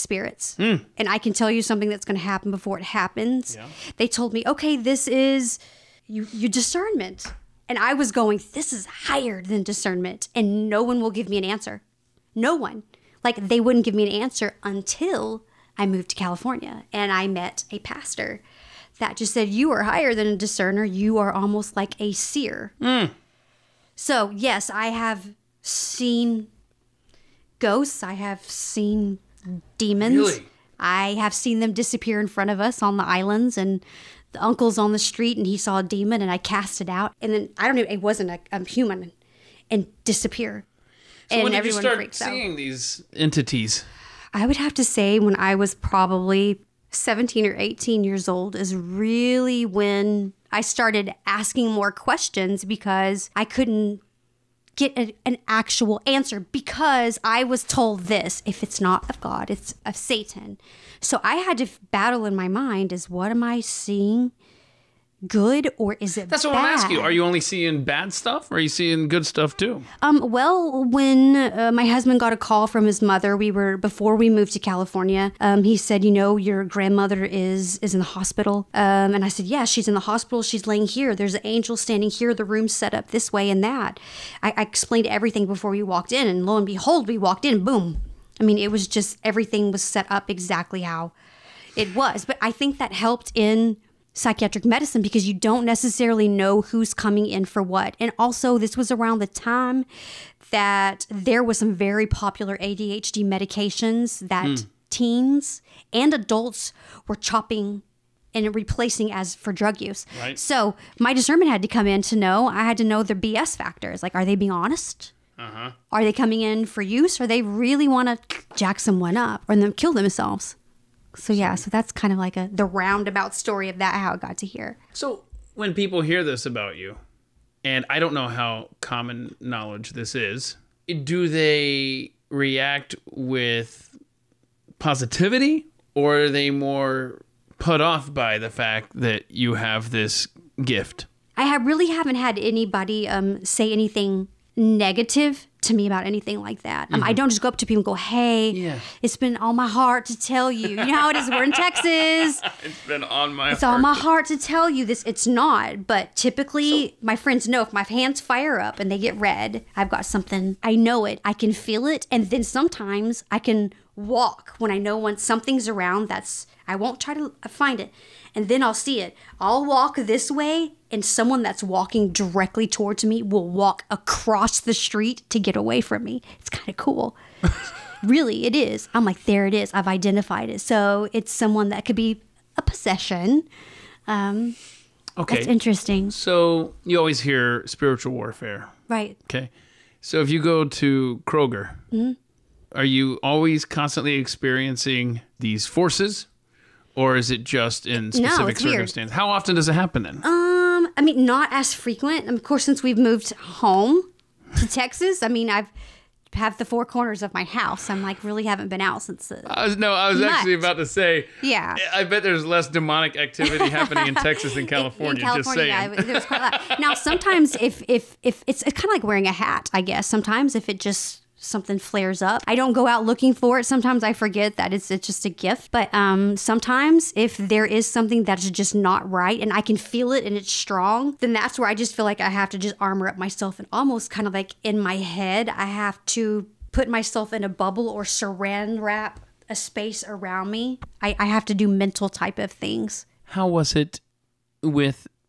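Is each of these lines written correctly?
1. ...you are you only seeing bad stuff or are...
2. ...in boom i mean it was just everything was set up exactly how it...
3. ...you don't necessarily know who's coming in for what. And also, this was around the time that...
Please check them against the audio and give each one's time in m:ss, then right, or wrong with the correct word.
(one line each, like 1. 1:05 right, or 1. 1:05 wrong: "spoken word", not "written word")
1. 1:06 right
2. 1:27 right
3. 1:35 right.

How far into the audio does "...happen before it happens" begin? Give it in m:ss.
0:02.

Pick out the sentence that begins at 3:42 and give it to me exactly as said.
I don't go out looking for it.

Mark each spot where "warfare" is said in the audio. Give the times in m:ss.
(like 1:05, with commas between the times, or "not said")
3:08.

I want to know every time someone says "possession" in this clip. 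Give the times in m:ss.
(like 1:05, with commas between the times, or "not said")
3:02.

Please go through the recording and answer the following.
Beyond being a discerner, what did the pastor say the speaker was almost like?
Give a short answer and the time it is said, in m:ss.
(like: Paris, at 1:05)
a seer, at 0:21.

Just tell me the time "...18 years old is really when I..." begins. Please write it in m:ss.
0:47.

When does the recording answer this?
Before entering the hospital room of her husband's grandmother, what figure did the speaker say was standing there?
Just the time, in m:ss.
1:21.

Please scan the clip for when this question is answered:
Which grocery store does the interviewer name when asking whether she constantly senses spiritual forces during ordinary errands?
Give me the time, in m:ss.
3:11.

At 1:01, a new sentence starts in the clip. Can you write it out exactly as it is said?
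So I had to battle in my mind is what am I seeing?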